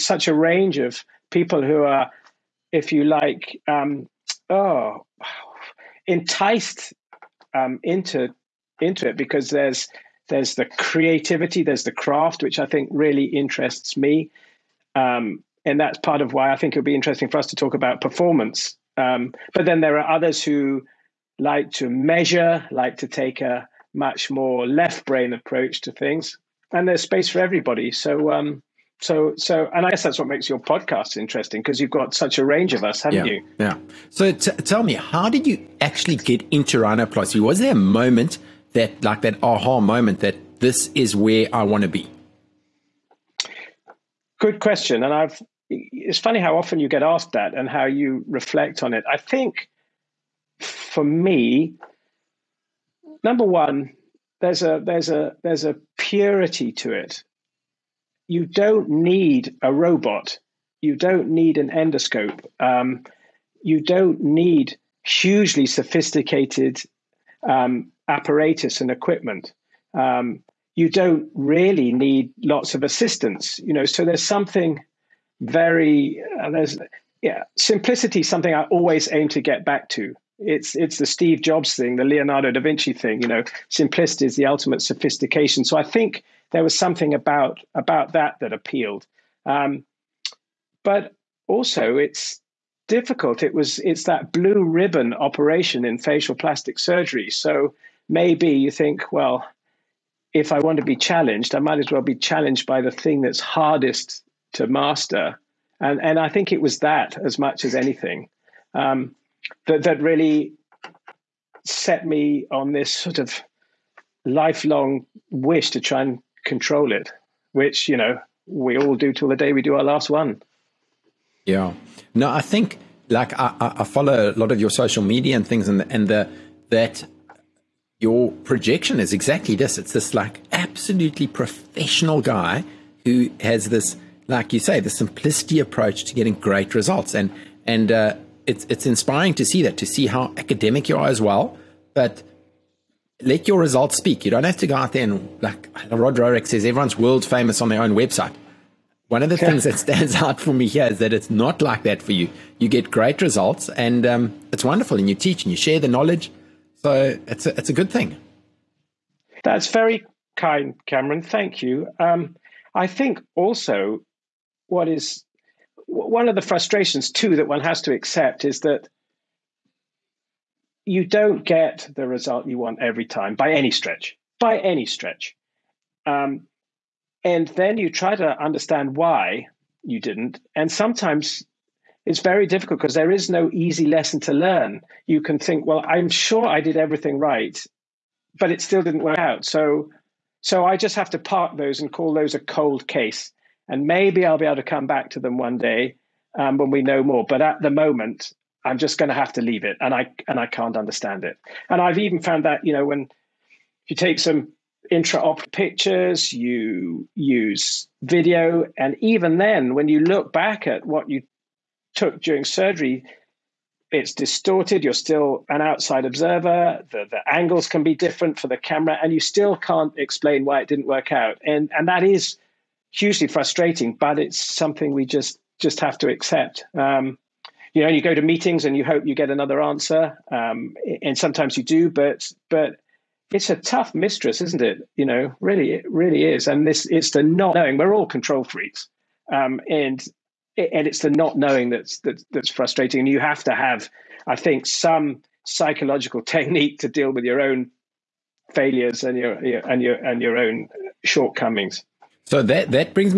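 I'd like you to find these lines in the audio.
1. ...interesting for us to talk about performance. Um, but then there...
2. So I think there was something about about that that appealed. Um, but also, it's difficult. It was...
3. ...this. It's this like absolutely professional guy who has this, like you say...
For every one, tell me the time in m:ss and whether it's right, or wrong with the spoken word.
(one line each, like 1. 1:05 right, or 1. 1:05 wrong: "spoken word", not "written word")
1. 0:16 right
2. 1:25 right
3. 2:09 right.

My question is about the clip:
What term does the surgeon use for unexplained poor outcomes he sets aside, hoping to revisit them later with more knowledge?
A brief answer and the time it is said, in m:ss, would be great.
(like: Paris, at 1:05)
cold case, at 3:12.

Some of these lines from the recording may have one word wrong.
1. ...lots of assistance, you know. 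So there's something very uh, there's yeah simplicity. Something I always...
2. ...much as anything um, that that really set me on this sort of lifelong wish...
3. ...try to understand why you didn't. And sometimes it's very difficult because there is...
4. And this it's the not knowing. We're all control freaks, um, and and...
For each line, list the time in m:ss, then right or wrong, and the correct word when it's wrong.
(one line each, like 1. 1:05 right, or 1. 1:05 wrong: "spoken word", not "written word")
1. 1:12 right
2. 1:47 right
3. 2:57 right
4. 3:56 right.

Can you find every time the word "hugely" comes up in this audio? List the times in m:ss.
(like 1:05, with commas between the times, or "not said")
1:05, 3:42.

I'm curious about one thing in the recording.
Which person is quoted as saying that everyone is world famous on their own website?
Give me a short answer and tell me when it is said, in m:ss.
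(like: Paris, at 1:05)
Rod Rohrich, at 2:25.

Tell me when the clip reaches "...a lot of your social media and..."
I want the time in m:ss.
2:04.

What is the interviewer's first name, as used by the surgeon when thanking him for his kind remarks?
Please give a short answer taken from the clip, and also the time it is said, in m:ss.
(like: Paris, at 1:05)
Cameron, at 2:40.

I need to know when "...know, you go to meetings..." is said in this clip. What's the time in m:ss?
3:47.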